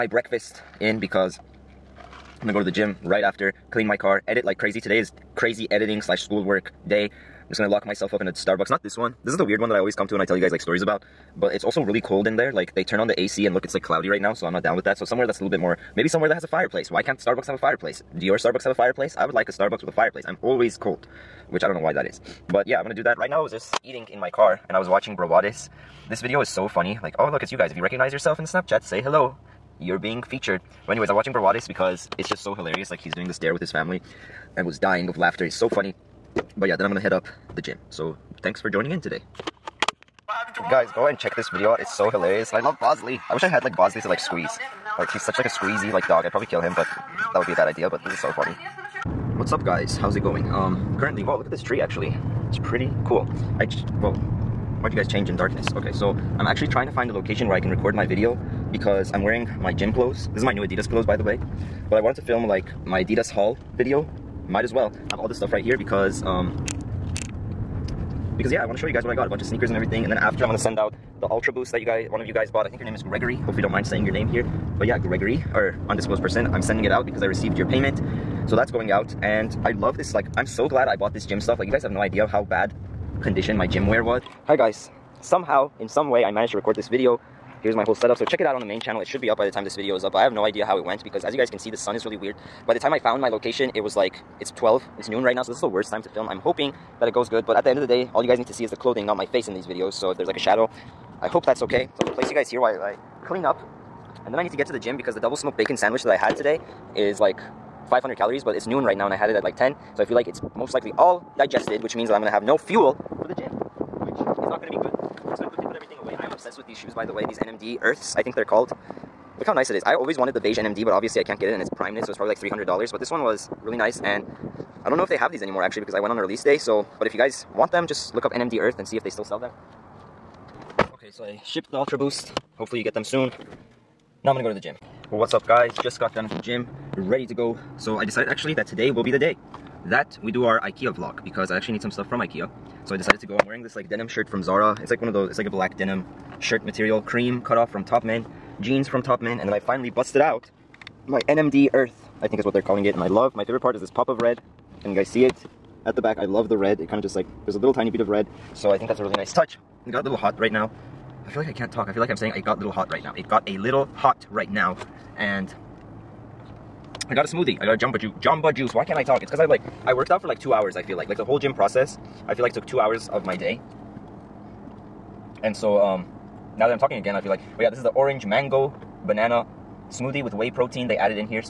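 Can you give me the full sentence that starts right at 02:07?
But if you guys want them, just look up NMD Earth and see if they still sell them.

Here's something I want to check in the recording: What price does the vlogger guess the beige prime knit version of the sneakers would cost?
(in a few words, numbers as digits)
$300.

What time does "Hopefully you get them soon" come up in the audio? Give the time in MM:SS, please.
02:12.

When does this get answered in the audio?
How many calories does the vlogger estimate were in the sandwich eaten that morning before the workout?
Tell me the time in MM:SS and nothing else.
01:47.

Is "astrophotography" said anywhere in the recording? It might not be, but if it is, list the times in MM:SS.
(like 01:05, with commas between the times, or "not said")
not said.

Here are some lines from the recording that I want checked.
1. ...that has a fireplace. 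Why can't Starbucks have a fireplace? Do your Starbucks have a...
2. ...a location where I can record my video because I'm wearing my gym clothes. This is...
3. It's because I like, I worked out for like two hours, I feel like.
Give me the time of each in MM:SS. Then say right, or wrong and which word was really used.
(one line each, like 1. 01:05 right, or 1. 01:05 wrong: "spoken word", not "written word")
1. 00:16 right
2. 00:57 right
3. 02:49 right.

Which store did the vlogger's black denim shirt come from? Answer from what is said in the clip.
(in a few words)
Zara.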